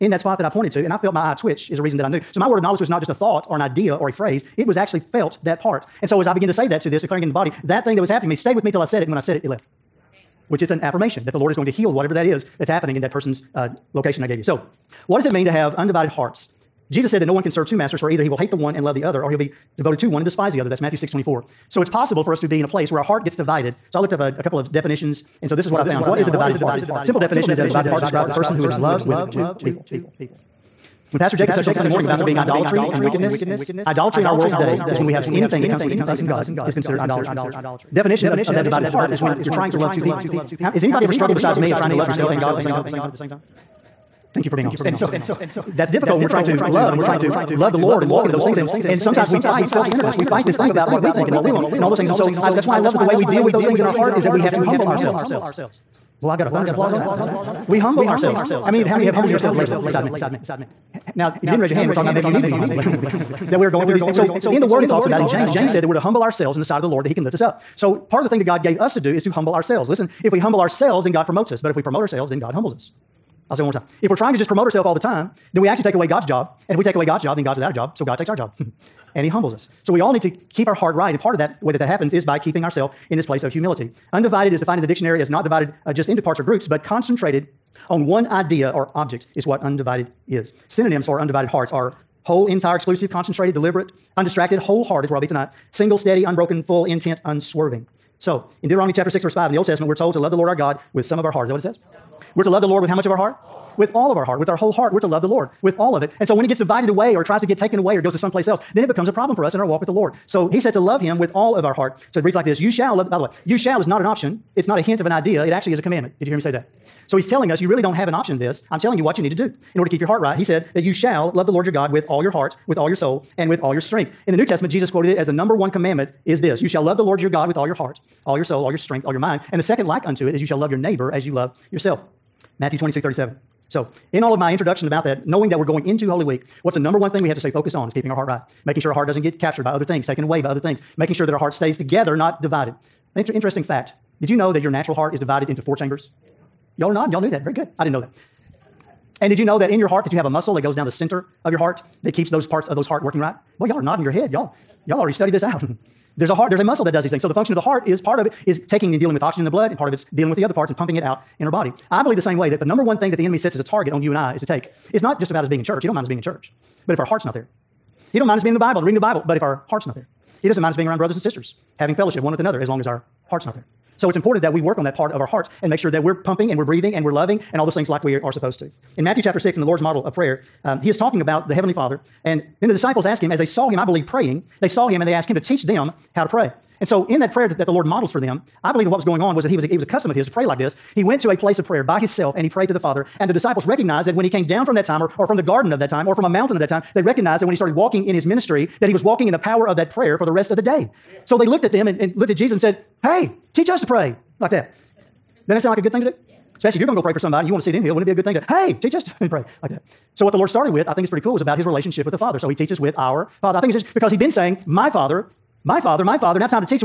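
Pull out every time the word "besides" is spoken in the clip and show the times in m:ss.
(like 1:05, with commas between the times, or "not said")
0:41, 0:59.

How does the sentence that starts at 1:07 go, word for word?
So part of the thing that God gave us to do is to humble ourselves.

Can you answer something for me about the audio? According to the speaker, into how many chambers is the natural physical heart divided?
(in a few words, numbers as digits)
4.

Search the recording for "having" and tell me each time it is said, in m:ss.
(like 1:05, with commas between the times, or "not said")
2:51.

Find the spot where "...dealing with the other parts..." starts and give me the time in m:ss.
2:40.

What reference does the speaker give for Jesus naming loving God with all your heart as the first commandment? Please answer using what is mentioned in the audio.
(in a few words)
Matthew 22:37.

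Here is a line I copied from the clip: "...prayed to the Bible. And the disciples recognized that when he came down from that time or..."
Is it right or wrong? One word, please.
wrong.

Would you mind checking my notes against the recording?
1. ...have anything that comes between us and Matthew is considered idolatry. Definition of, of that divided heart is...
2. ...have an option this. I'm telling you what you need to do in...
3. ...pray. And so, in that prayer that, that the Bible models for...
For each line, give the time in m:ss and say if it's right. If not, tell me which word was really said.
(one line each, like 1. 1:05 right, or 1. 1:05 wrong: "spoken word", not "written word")
1. 0:35 wrong: "God", not "Matthew"
2. 1:57 right
3. 3:06 wrong: "Lord", not "Bible".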